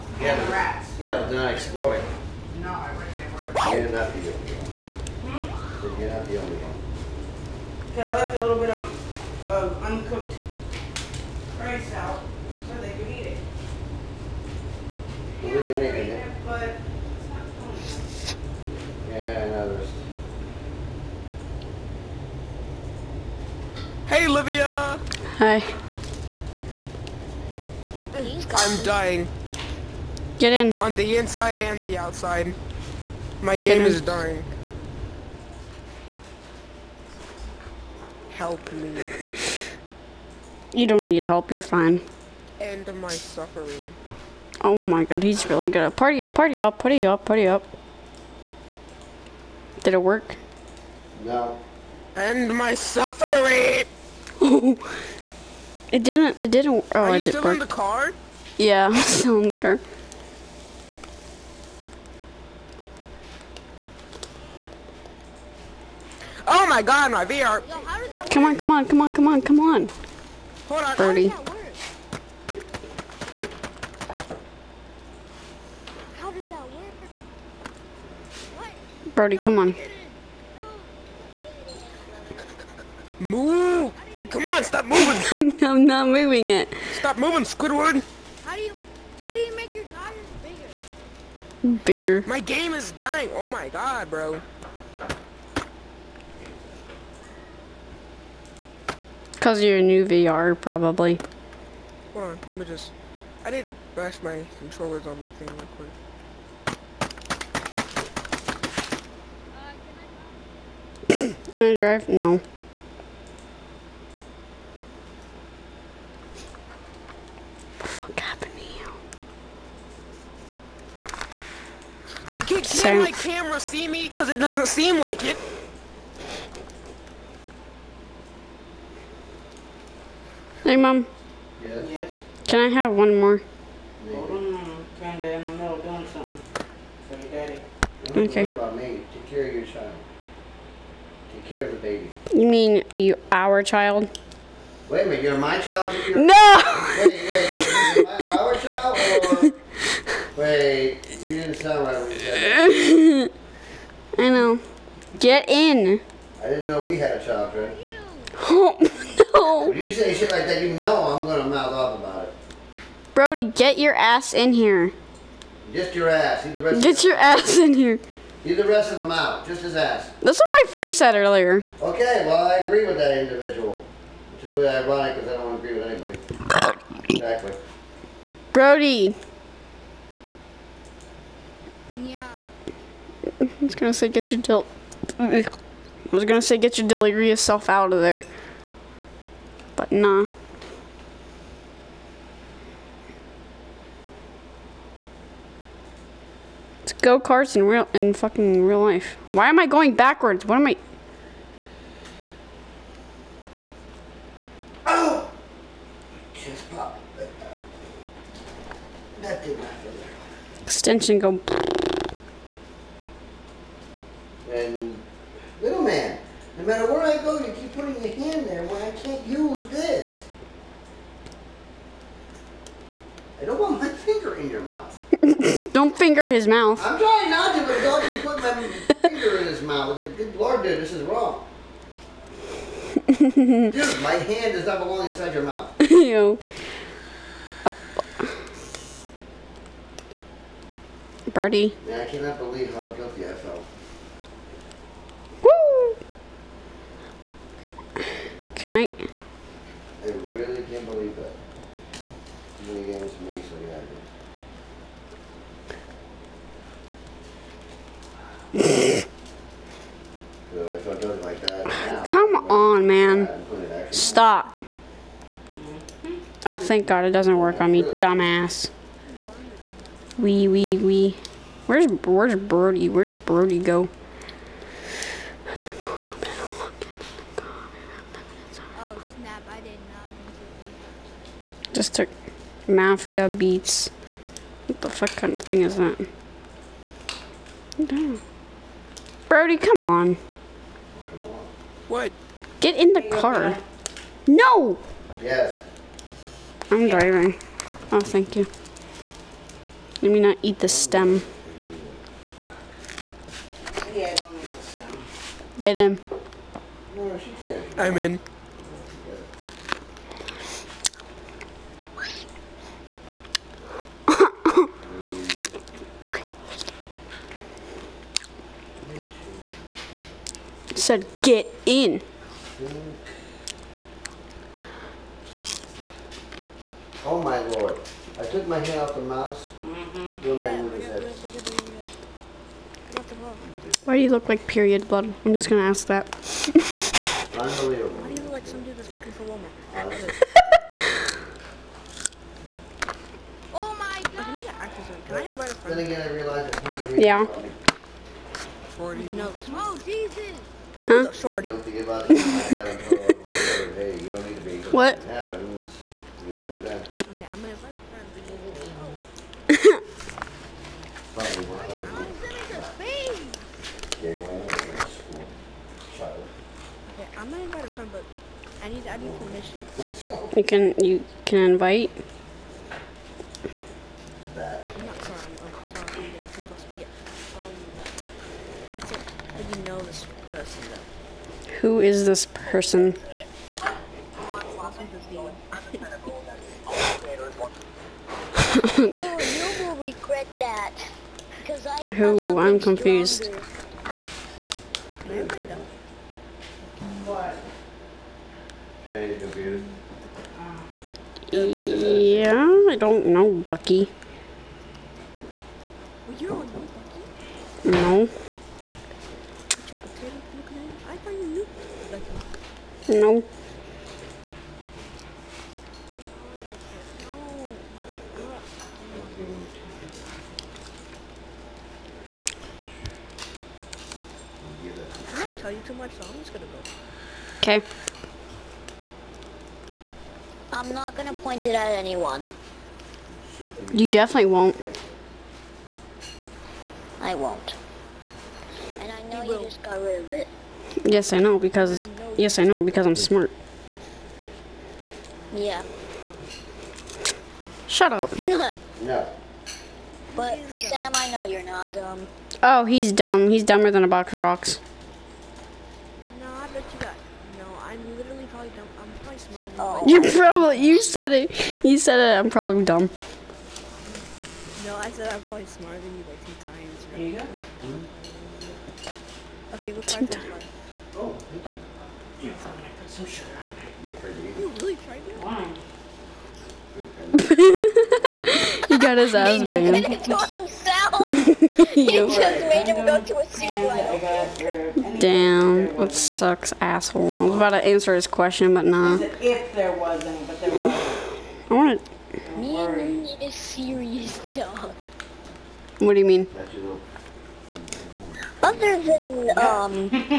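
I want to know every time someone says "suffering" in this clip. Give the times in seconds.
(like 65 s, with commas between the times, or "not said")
43 s, 52 s.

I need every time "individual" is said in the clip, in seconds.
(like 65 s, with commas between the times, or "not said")
173 s.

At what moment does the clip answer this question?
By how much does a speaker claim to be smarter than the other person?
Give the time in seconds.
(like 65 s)
466 s.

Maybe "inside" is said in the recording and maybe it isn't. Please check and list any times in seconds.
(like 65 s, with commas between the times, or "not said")
31 s, 235 s.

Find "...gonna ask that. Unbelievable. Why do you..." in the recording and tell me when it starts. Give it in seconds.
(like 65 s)
335 s.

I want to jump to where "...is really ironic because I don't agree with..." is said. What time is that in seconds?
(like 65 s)
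174 s.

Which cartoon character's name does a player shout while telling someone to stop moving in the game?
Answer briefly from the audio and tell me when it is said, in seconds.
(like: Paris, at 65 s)
Squidward, at 87 s.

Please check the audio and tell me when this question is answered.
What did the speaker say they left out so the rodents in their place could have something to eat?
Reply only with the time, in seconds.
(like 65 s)
9 s.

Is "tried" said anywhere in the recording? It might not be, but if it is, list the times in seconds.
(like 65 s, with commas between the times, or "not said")
474 s.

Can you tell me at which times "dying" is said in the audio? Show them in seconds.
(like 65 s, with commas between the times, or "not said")
28 s, 34 s, 92 s.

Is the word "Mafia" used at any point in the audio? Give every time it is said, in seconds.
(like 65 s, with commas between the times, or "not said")
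282 s.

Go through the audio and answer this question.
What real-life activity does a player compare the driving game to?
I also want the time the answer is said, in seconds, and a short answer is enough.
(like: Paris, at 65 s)
go karts, at 196 s.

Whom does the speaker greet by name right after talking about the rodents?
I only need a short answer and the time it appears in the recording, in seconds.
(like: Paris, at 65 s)
Livia, at 24 s.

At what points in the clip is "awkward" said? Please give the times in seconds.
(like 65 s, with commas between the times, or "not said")
not said.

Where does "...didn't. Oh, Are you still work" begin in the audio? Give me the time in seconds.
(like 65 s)
56 s.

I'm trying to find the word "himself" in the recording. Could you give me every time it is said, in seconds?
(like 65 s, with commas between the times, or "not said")
480 s.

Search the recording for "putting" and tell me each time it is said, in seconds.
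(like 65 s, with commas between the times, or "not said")
217 s, 228 s.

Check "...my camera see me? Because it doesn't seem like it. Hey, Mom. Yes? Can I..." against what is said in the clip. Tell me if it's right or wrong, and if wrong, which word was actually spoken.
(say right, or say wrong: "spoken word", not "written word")
right.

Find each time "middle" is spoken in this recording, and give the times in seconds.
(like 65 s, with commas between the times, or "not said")
135 s.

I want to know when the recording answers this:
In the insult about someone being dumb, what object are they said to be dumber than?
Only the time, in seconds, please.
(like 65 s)
453 s.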